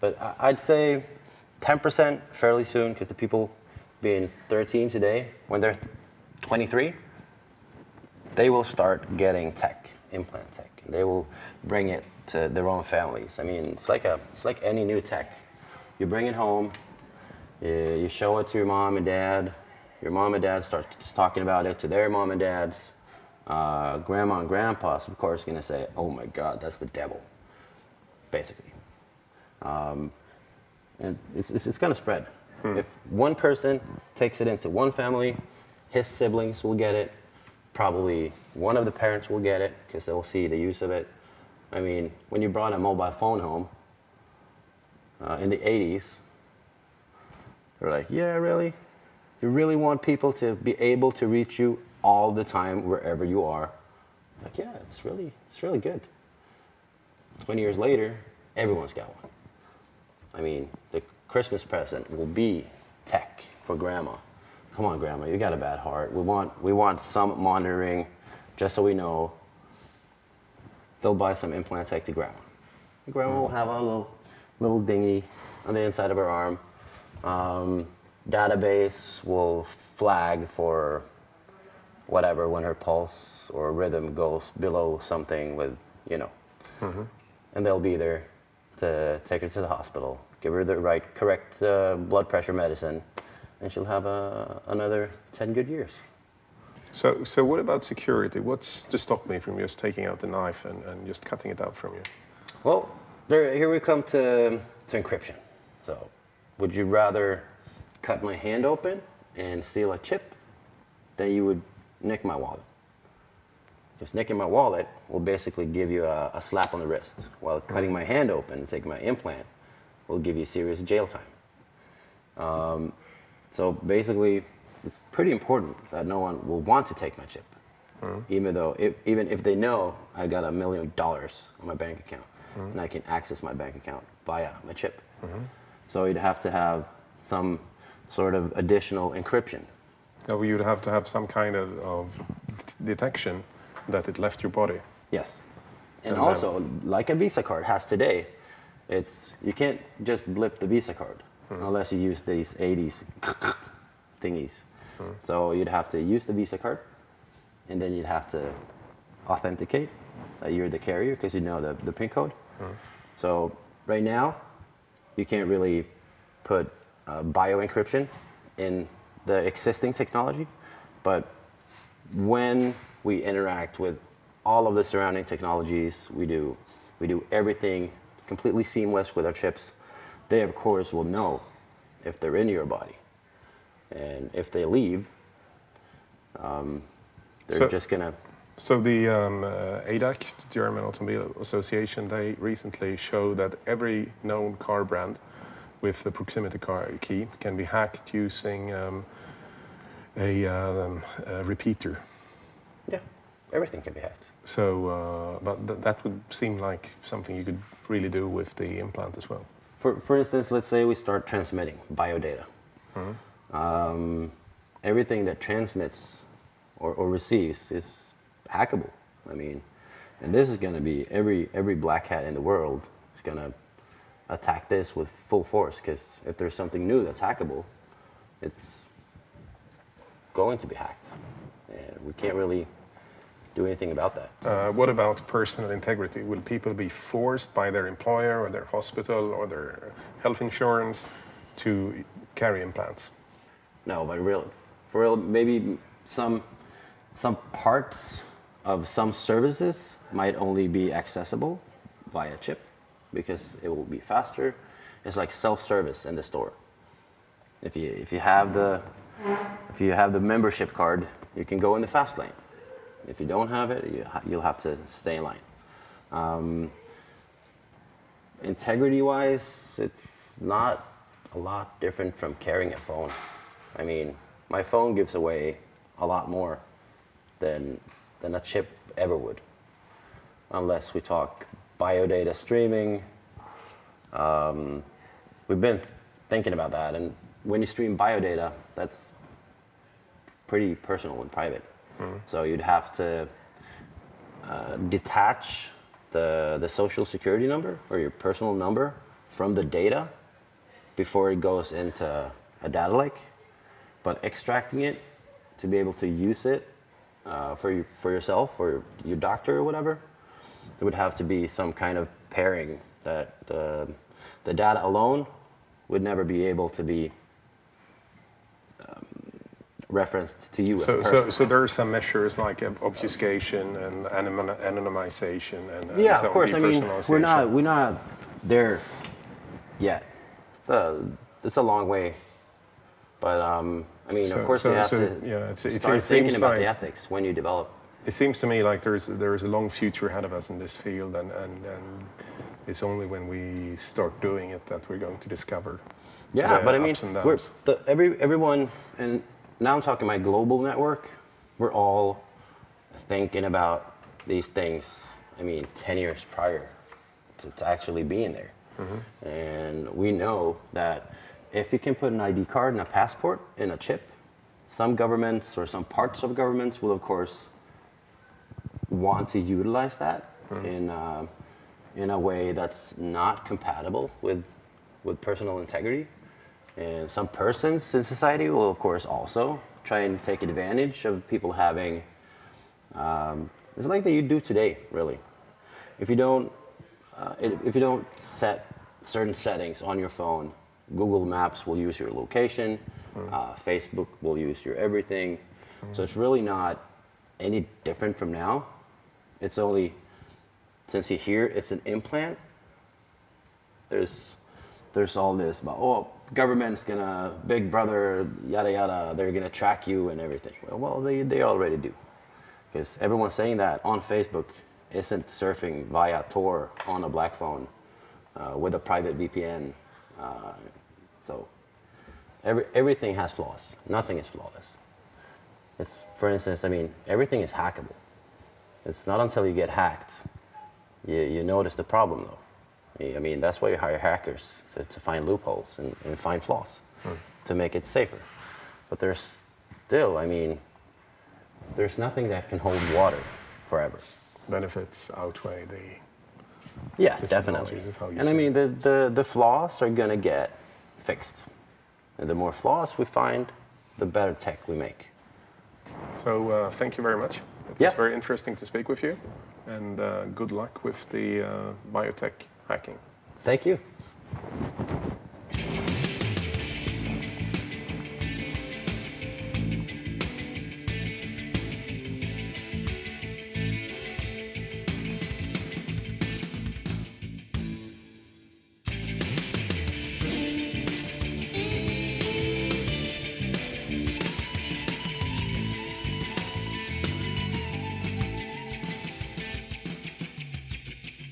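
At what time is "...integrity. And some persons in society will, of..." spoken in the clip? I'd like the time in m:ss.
6:15.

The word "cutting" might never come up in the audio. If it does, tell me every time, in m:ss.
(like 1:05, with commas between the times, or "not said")
1:41, 1:57.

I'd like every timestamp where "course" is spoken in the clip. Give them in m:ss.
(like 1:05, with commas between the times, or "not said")
0:25, 3:00, 5:26, 5:34, 6:06, 6:18.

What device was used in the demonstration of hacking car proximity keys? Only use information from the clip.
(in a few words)
a repeater.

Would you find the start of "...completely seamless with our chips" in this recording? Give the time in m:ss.
2:58.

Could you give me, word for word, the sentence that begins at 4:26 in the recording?
Um, Integrity-wise, it's not a lot different from carrying a phone.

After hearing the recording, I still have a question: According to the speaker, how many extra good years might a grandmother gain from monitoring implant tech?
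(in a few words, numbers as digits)
10.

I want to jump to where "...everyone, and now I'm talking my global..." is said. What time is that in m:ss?
5:48.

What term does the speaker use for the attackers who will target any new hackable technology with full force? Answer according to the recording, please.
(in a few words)
black hat.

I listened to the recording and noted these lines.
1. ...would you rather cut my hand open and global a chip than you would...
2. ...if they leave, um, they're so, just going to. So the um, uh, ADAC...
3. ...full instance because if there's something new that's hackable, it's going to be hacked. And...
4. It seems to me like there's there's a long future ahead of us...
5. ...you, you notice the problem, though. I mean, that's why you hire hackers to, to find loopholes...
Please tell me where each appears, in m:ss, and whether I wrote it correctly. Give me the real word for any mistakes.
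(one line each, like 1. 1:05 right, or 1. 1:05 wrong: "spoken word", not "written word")
1. 1:46 wrong: "steal", not "global"
2. 3:04 right
3. 3:45 wrong: "force", not "instance"
4. 5:38 right
5. 7:11 right.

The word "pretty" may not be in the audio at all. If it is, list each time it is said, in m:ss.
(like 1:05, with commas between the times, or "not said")
2:05, 4:50.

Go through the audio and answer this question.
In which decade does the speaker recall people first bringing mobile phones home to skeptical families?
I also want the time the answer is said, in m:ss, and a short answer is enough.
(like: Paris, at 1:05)
1980s, at 0:45.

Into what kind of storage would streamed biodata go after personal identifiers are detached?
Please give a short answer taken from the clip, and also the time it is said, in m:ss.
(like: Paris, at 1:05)
data lake, at 5:02.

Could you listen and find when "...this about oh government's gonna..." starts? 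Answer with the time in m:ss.
6:45.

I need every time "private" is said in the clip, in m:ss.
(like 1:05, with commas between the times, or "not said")
4:51, 6:58.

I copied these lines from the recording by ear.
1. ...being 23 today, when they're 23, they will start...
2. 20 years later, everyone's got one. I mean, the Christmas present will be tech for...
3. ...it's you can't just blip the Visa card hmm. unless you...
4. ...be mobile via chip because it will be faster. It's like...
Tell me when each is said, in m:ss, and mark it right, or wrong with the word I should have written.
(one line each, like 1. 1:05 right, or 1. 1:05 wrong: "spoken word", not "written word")
1. 0:03 wrong: "13", not "23"
2. 0:57 right
3. 2:28 right
4. 4:10 wrong: "accessible", not "mobile".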